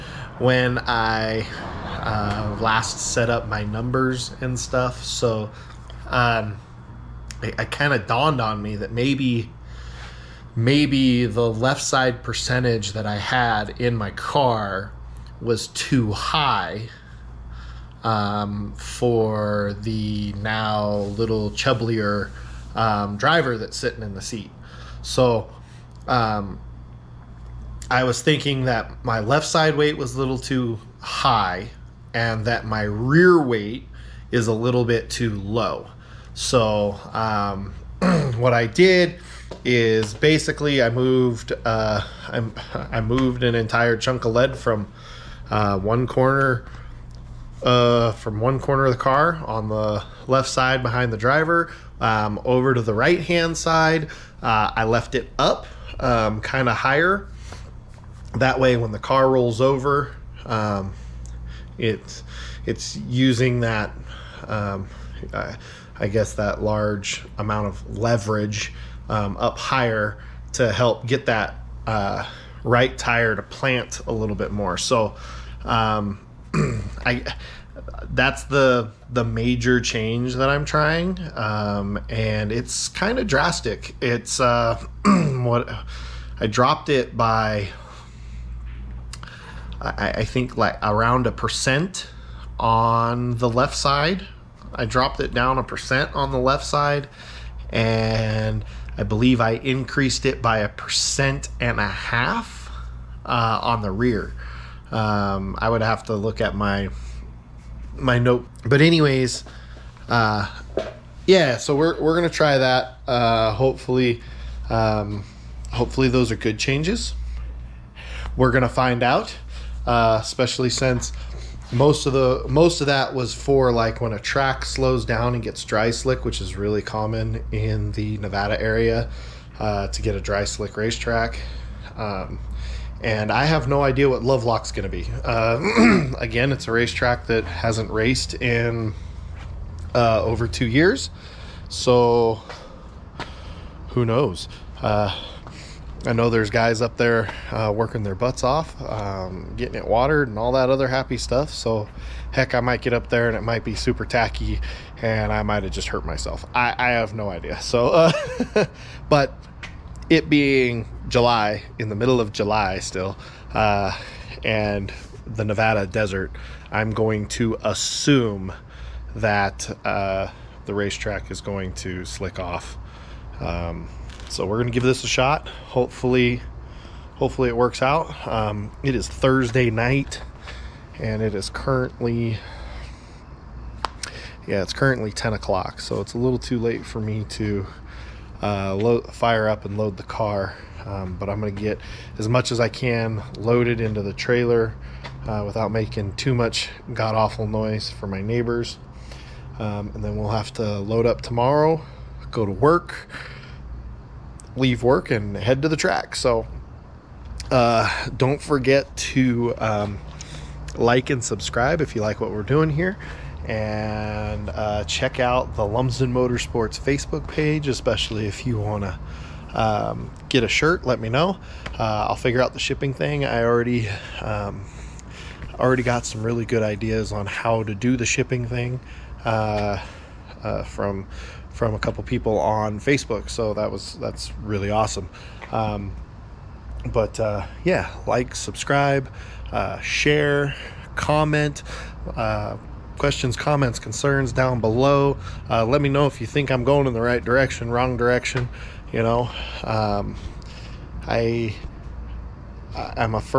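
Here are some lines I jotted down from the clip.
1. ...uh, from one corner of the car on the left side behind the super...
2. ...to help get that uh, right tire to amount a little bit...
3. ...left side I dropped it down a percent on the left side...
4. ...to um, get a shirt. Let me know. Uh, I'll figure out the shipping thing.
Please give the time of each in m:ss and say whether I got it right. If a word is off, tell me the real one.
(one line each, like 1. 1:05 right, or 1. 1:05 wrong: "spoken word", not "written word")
1. 0:47 wrong: "driver", not "super"
2. 1:10 wrong: "plant", not "amount"
3. 1:33 right
4. 3:38 right.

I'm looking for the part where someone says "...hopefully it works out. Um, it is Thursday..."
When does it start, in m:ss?
2:57.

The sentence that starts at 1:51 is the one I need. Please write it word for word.
So we're we're gonna try that.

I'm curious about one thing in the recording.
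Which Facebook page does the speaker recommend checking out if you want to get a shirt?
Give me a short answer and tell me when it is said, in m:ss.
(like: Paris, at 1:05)
Lumsden Motorsports, at 3:35.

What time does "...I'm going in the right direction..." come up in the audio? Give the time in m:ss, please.
4:06.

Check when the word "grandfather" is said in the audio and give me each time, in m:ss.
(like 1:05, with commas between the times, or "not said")
not said.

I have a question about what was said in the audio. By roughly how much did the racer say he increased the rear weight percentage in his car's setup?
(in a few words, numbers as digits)
1.5 percent.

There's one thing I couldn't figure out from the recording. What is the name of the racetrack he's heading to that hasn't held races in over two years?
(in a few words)
Lovelock.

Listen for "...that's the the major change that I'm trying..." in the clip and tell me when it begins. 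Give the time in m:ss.
1:18.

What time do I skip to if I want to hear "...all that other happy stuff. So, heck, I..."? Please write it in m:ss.
2:30.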